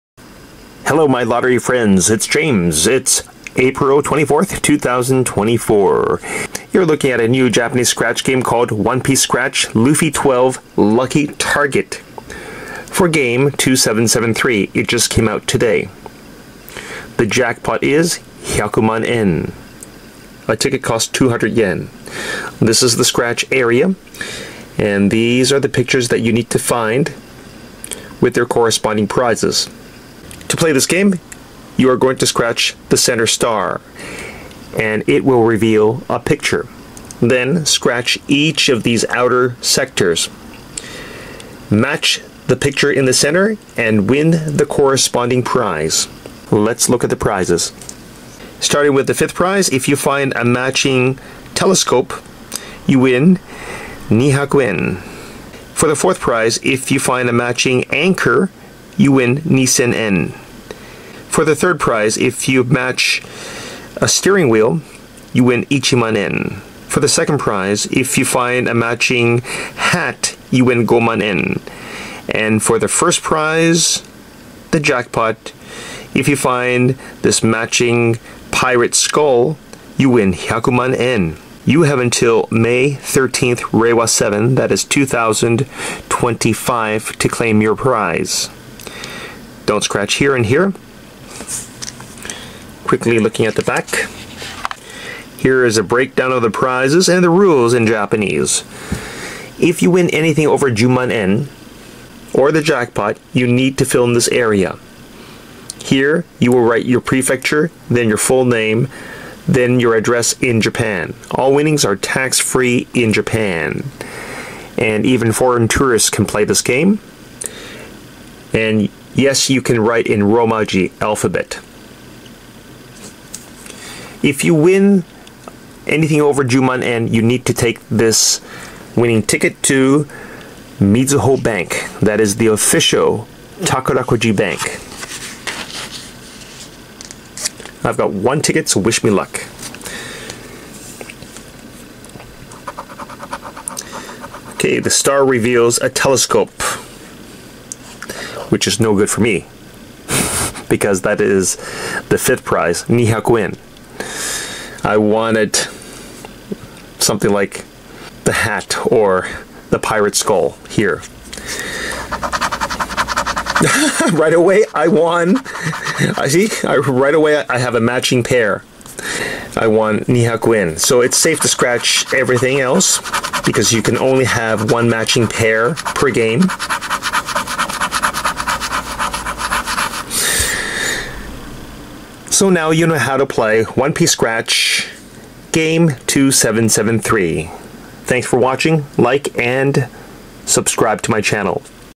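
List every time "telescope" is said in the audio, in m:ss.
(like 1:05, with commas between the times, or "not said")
0:51, 2:25.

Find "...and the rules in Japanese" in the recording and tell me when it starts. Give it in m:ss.
1:37.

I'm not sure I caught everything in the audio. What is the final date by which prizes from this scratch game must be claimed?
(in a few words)
May 13th, 2025.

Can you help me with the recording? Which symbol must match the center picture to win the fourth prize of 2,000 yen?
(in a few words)
anchor.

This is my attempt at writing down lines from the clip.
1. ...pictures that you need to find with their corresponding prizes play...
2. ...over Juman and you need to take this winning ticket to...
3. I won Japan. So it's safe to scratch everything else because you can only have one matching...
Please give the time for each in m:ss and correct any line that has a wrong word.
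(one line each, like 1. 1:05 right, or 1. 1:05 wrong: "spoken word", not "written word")
1. 0:25 right
2. 2:06 right
3. 2:49 wrong: "Nihakuen", not "Japan".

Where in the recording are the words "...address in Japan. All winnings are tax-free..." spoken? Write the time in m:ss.
1:49.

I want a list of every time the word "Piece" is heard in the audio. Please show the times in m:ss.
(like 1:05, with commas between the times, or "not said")
0:08, 3:03.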